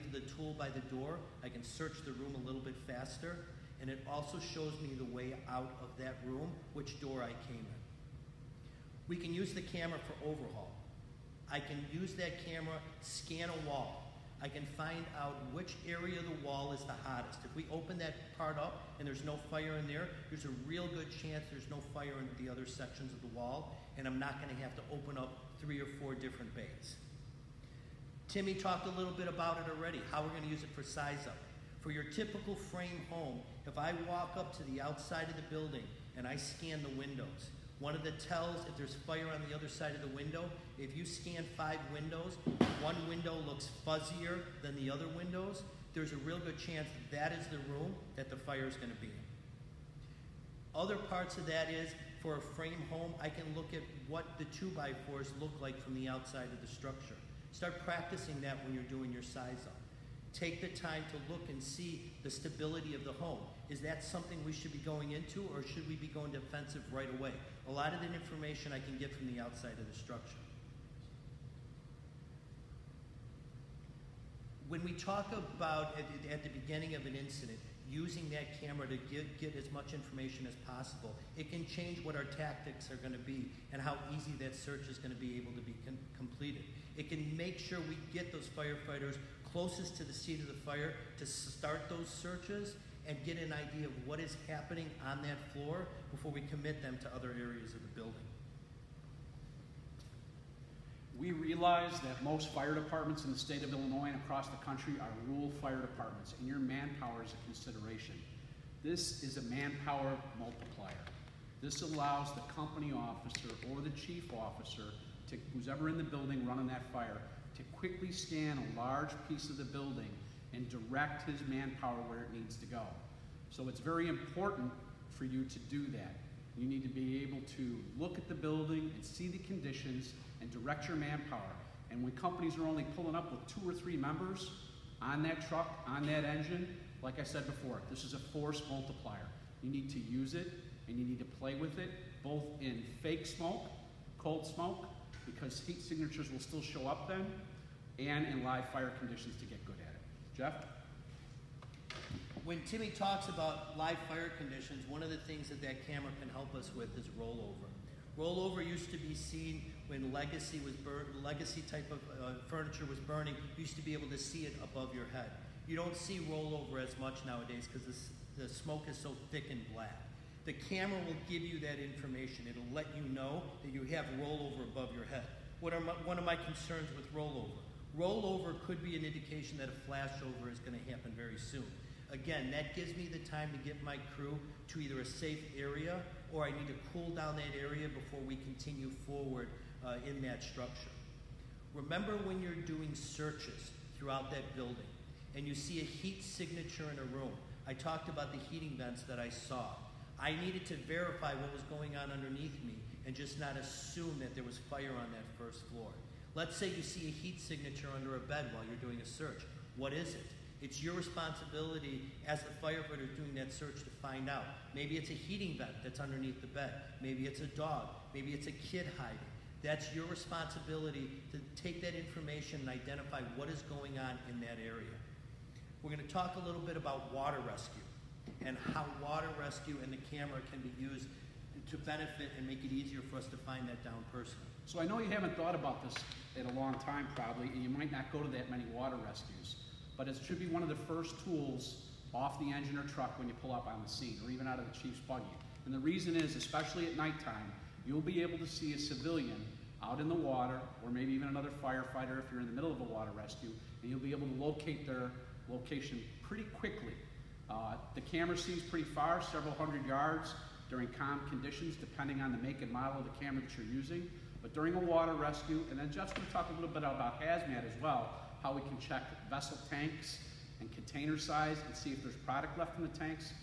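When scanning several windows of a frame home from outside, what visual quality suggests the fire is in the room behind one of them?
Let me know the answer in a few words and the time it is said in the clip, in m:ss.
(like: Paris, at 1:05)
Fuzzier, at 0:43.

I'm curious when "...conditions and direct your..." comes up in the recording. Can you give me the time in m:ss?
2:09.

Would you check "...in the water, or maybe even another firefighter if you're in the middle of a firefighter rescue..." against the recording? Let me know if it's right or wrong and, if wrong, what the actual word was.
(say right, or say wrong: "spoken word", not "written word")
wrong: "water", not "firefighter".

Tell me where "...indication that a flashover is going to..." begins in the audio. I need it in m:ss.
2:59.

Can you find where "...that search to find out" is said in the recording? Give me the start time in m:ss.
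3:33.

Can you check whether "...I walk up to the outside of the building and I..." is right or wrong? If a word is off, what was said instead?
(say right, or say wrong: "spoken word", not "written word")
right.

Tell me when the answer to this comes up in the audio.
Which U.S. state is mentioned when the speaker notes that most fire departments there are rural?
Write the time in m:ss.
1:43.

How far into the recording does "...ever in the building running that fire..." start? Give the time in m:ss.
1:55.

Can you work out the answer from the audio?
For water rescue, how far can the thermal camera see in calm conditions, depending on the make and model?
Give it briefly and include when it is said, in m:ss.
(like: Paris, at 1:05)
Several hundred yards, at 4:19.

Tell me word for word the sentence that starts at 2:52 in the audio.
It'll let you know that you have rollover above your head.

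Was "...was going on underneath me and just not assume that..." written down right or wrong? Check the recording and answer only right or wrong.
right.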